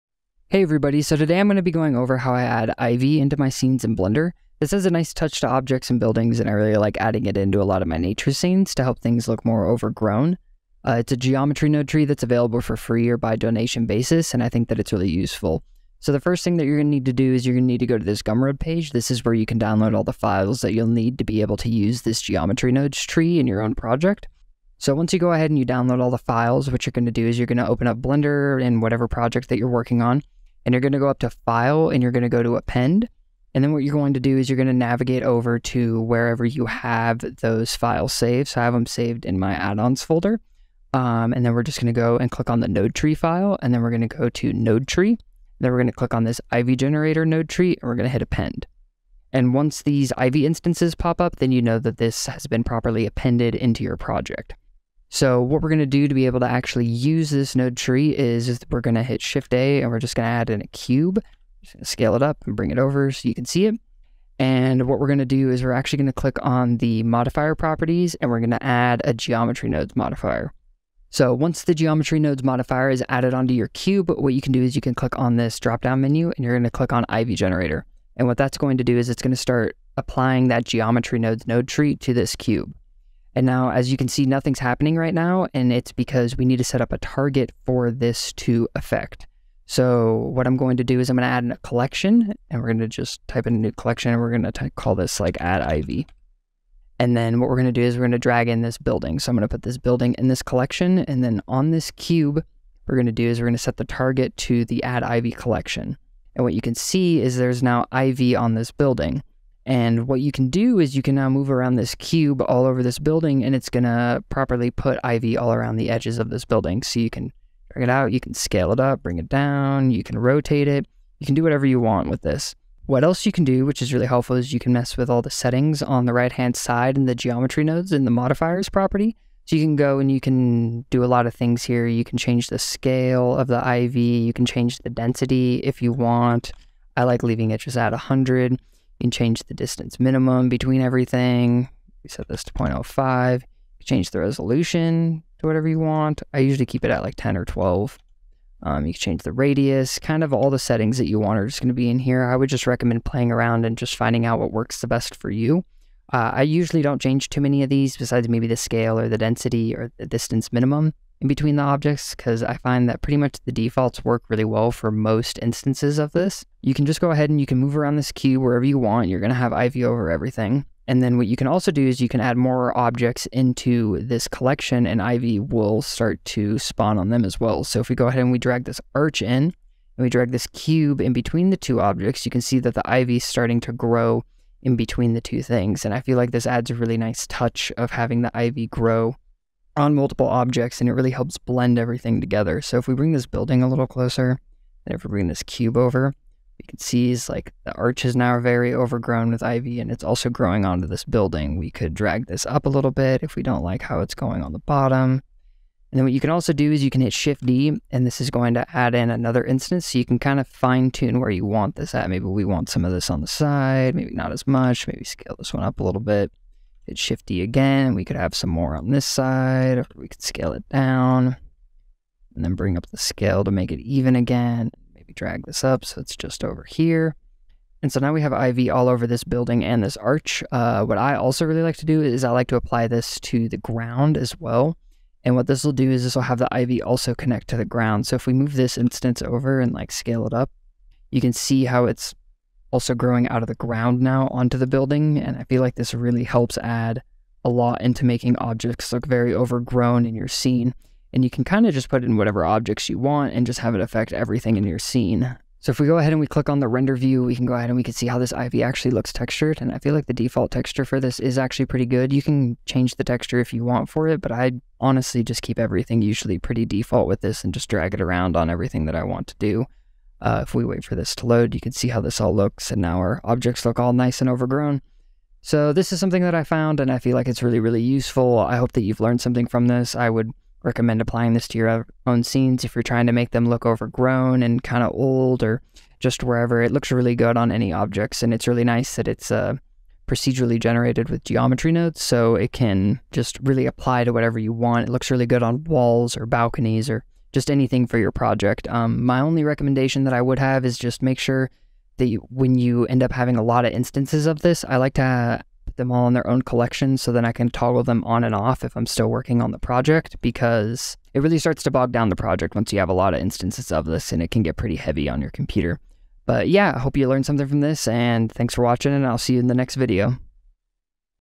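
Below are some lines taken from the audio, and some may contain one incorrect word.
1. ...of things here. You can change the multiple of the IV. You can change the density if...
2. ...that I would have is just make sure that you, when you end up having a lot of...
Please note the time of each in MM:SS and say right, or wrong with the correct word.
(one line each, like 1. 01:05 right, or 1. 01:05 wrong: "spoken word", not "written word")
1. 02:11 wrong: "scale", not "multiple"
2. 05:00 right.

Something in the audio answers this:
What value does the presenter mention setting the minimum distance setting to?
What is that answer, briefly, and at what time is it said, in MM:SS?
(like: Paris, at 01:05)
0.05, at 02:22.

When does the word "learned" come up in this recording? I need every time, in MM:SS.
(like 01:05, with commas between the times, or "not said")
04:39, 05:17.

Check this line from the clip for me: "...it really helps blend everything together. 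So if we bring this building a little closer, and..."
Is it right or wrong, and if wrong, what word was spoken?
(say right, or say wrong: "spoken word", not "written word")
right.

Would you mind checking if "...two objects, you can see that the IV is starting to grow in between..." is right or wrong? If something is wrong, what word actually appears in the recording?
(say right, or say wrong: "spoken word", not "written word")
right.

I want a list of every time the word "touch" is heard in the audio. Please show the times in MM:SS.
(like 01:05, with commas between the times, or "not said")
00:05, 03:07.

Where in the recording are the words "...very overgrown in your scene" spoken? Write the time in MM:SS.
04:09.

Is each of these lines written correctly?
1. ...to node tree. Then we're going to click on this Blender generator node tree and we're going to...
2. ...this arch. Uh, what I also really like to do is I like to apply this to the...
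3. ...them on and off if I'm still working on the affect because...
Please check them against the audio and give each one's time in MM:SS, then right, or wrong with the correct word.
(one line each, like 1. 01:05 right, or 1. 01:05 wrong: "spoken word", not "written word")
1. 00:44 wrong: "Ivy", not "Blender"
2. 03:49 right
3. 05:07 wrong: "project", not "affect".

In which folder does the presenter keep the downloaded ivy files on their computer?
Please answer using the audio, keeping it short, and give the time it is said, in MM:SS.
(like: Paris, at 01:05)
add-ons folder, at 00:39.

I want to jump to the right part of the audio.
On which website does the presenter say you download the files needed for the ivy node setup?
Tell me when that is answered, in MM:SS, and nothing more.
00:18.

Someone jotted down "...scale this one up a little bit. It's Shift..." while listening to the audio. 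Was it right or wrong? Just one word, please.
right.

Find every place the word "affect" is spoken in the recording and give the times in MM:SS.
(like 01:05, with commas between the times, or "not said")
01:28, 04:13.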